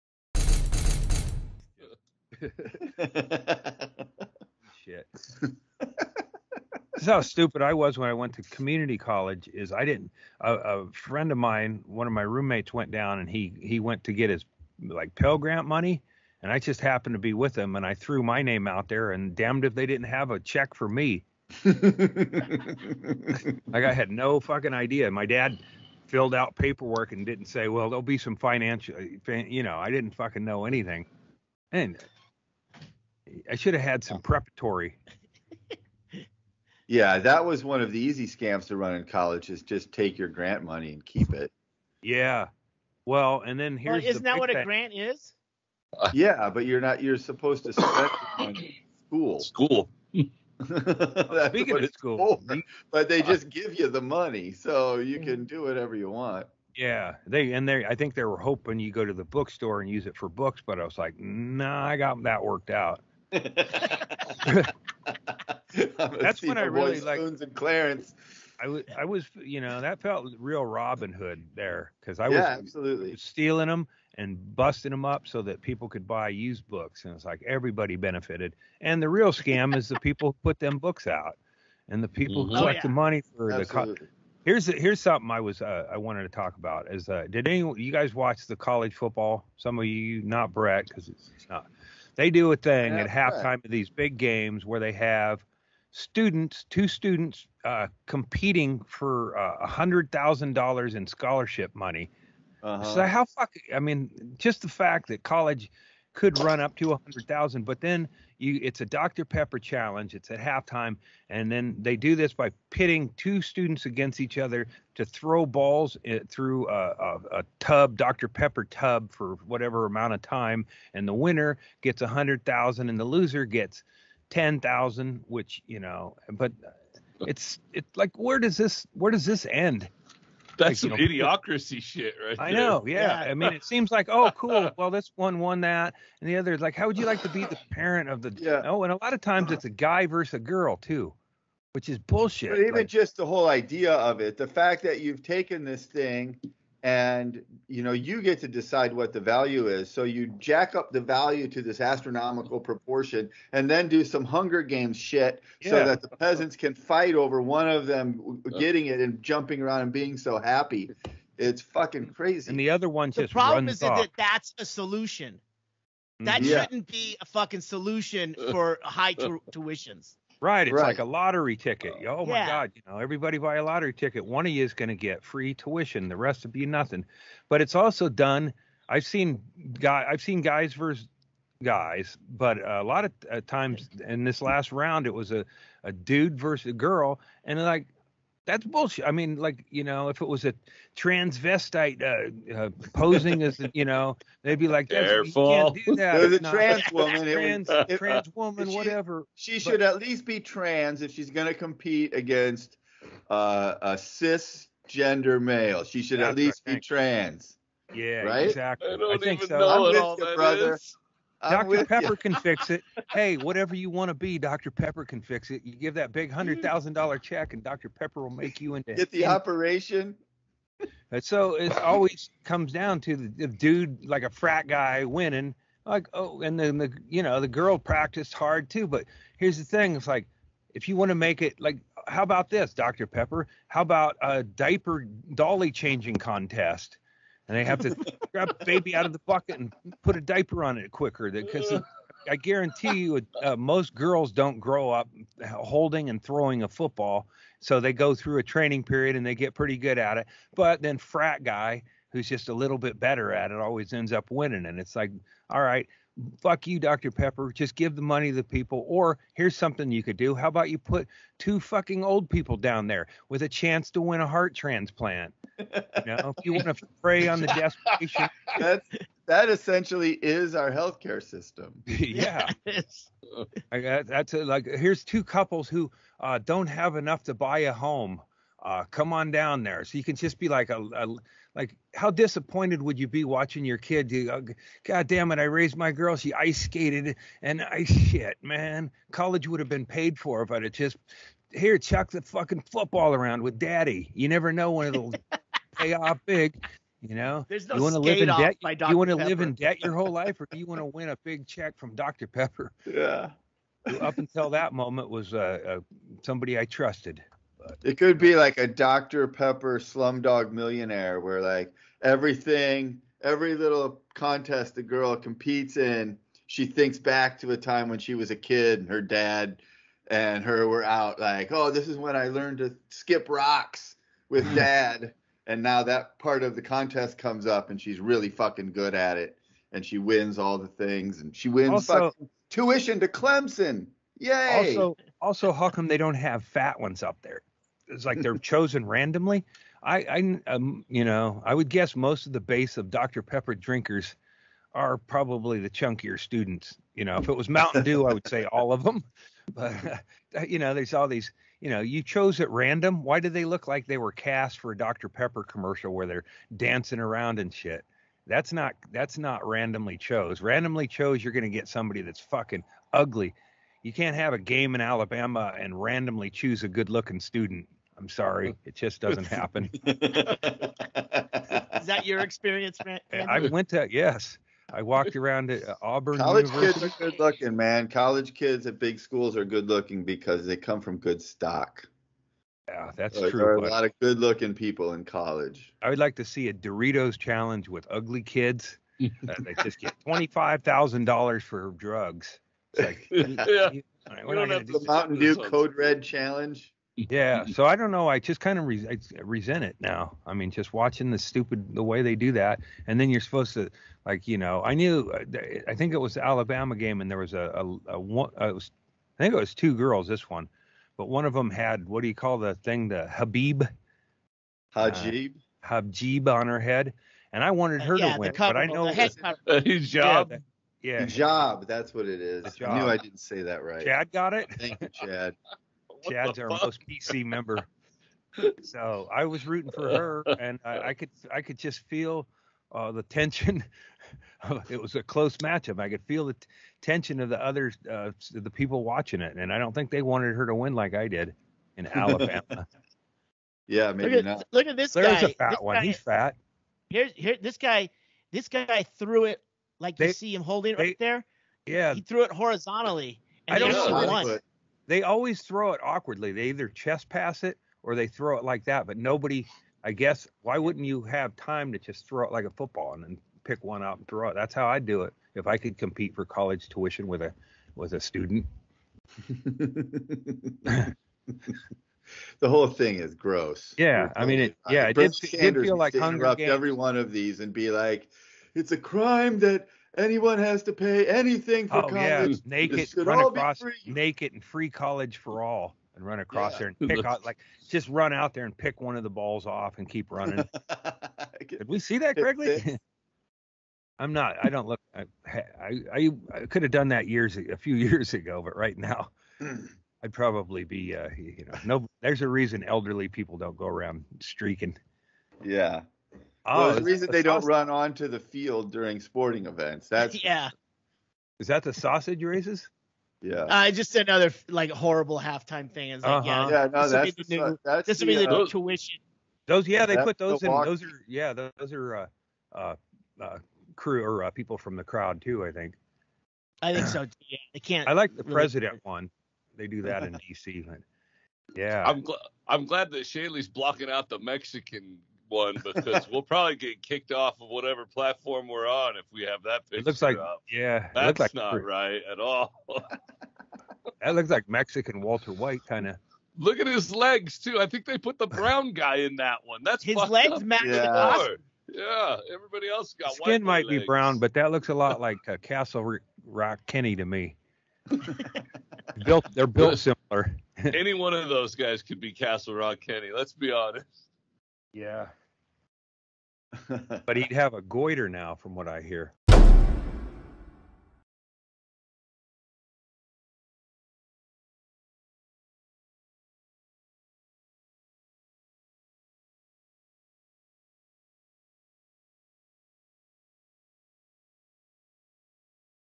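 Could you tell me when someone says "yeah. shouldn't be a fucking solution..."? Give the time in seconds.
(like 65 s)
166 s.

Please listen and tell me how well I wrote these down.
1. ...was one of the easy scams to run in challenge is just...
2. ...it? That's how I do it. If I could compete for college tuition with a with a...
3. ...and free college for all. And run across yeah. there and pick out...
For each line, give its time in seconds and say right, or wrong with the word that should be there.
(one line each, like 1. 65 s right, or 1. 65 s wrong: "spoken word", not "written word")
1. 37 s wrong: "college", not "challenge"
2. 464 s right
3. 484 s right.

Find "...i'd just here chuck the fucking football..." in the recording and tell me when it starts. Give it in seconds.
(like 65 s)
290 s.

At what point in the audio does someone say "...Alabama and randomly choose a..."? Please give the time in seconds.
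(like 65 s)
364 s.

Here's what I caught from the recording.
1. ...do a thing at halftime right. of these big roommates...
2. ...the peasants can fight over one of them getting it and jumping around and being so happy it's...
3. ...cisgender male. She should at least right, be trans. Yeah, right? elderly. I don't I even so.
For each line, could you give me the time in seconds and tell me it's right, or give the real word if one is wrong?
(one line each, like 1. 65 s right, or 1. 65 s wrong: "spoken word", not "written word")
1. 92 s wrong: "games", not "roommates"
2. 156 s right
3. 203 s wrong: "exactly", not "elderly".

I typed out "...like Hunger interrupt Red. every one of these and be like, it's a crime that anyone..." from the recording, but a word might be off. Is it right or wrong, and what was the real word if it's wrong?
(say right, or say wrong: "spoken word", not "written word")
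wrong: "Games", not "Red".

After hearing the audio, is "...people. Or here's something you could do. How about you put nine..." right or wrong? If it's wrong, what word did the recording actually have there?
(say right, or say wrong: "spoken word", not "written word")
wrong: "two", not "nine".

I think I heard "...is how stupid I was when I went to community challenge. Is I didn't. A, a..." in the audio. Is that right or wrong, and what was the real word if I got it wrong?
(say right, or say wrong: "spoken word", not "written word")
wrong: "college", not "challenge".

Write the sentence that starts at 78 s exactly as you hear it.
And the real scam is the people who put them books out, and the people who mm-hmm.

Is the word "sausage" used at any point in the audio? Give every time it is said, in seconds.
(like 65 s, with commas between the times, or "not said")
507 s, 511 s.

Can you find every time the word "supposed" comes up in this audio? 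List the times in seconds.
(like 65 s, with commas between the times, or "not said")
47 s, 403 s.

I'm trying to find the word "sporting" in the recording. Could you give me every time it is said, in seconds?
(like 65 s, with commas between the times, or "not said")
508 s.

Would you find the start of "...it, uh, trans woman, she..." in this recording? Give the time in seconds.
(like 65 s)
197 s.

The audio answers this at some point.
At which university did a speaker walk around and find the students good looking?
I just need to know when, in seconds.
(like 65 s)
375 s.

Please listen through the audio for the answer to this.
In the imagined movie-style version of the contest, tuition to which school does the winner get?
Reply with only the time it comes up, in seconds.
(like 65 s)
333 s.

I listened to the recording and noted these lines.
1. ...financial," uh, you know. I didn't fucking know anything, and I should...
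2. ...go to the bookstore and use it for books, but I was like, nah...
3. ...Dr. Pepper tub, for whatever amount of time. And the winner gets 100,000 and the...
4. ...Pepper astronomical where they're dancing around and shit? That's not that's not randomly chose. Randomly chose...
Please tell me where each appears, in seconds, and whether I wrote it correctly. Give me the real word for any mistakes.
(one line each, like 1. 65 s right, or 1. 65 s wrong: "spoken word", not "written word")
1. 28 s right
2. 58 s right
3. 117 s right
4. 355 s wrong: "commercial", not "astronomical".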